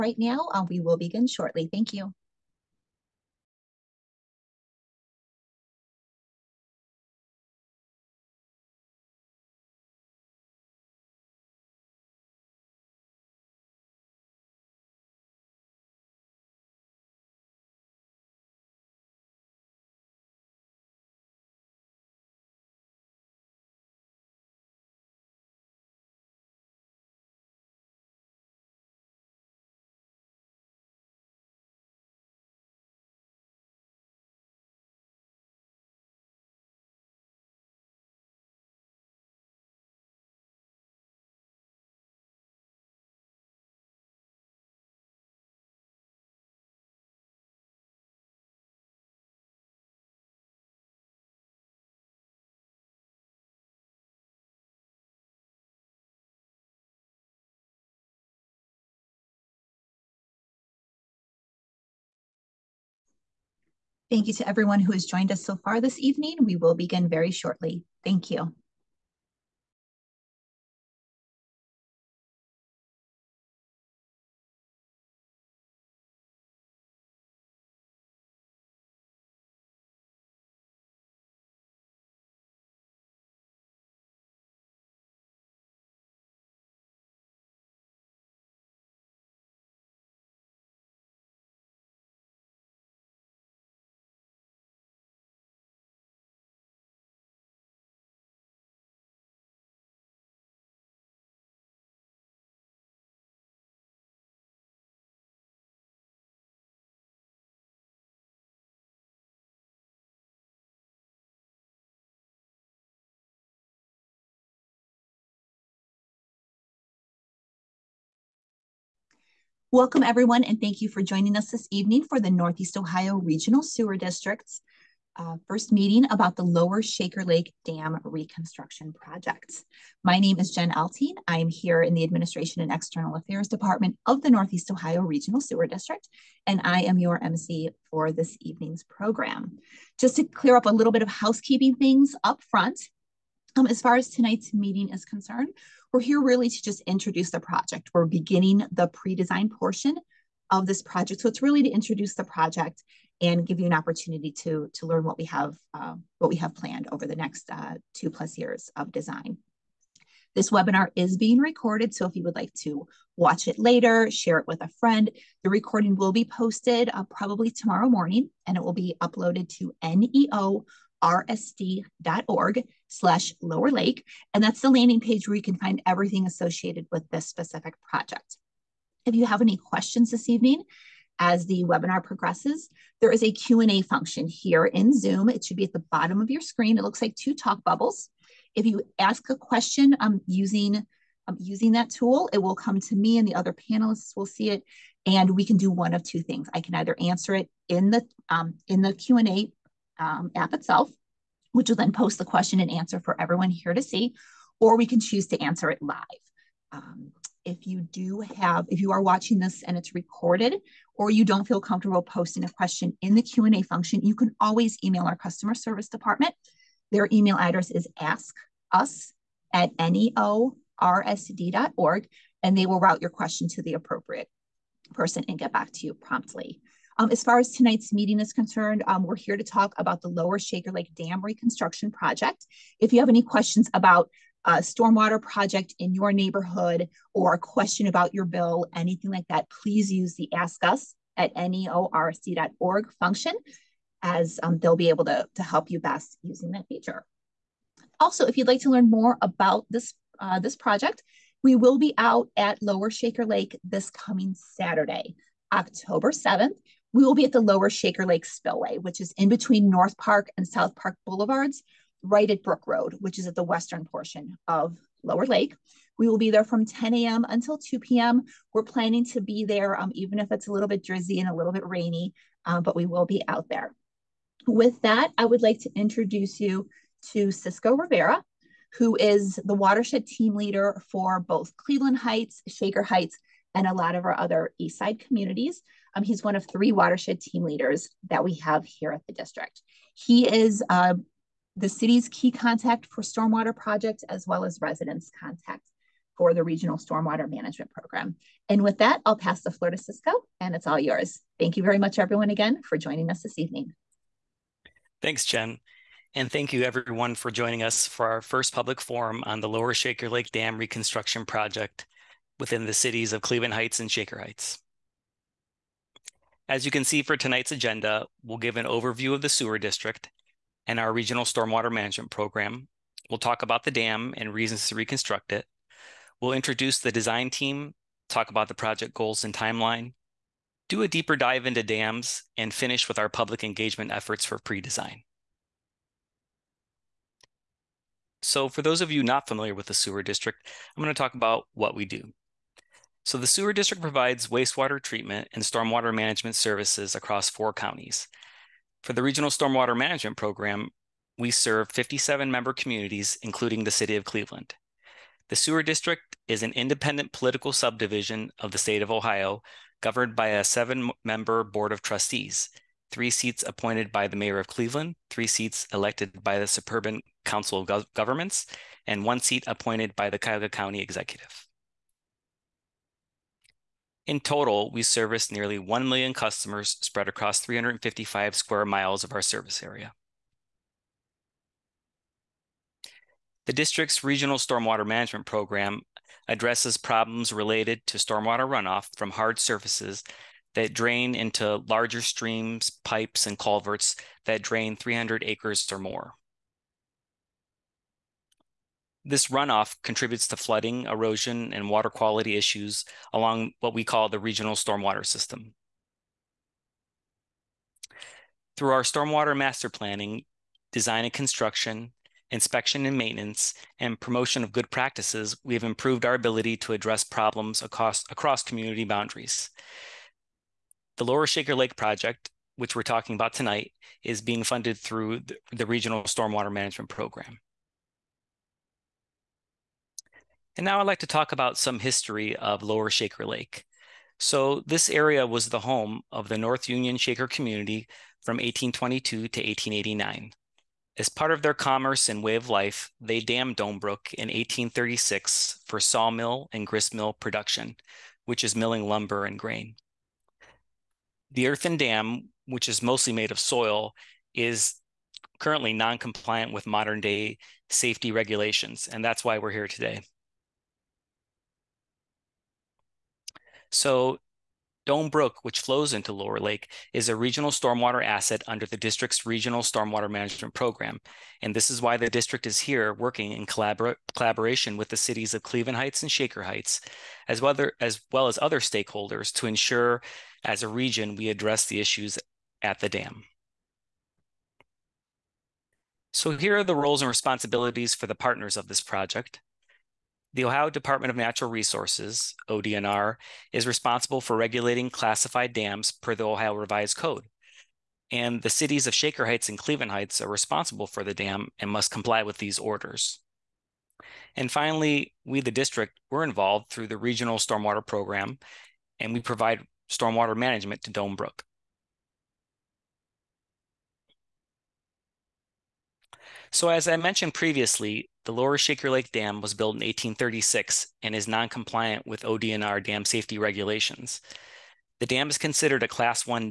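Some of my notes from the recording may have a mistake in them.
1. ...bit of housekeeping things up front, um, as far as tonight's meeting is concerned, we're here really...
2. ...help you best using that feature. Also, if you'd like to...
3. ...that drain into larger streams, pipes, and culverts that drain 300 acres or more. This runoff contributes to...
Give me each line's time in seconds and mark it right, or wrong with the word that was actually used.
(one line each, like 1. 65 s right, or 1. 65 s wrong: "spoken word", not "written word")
1. 140 s right
2. 245 s right
3. 390 s right.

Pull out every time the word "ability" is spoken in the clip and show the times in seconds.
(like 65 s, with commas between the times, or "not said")
416 s.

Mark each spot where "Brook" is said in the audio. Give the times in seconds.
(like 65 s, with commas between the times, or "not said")
262 s, 443 s, 465 s, 511 s.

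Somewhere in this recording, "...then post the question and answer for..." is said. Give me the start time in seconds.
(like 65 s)
201 s.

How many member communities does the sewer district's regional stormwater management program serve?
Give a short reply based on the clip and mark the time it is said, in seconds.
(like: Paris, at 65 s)
57, at 351 s.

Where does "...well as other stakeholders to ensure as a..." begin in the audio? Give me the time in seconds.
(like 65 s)
478 s.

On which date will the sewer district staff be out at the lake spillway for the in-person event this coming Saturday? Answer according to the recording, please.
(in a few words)
October 7th.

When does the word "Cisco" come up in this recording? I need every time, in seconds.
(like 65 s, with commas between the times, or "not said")
277 s, 299 s.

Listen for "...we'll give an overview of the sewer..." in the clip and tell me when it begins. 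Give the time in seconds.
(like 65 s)
318 s.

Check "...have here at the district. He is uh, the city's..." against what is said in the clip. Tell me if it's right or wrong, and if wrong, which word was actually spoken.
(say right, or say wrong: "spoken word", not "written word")
right.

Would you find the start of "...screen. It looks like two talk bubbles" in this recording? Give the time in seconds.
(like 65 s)
186 s.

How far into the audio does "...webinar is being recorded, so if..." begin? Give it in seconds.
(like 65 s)
160 s.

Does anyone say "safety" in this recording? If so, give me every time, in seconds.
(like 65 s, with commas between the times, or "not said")
457 s, 523 s.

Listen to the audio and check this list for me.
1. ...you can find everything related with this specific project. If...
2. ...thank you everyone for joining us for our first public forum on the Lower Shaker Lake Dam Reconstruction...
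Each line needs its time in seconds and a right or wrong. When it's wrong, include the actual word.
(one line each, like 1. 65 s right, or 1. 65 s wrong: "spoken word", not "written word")
1. 175 s wrong: "associated", not "related"
2. 306 s right.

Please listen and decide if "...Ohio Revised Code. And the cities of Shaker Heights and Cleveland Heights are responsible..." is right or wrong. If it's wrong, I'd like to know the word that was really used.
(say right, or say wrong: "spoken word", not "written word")
right.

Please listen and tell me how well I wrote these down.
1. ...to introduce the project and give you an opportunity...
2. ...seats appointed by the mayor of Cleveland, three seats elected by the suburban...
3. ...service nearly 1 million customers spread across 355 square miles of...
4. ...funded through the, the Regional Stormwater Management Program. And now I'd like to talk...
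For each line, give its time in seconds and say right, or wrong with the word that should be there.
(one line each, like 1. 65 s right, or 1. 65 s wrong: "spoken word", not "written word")
1. 151 s right
2. 363 s right
3. 374 s right
4. 424 s right.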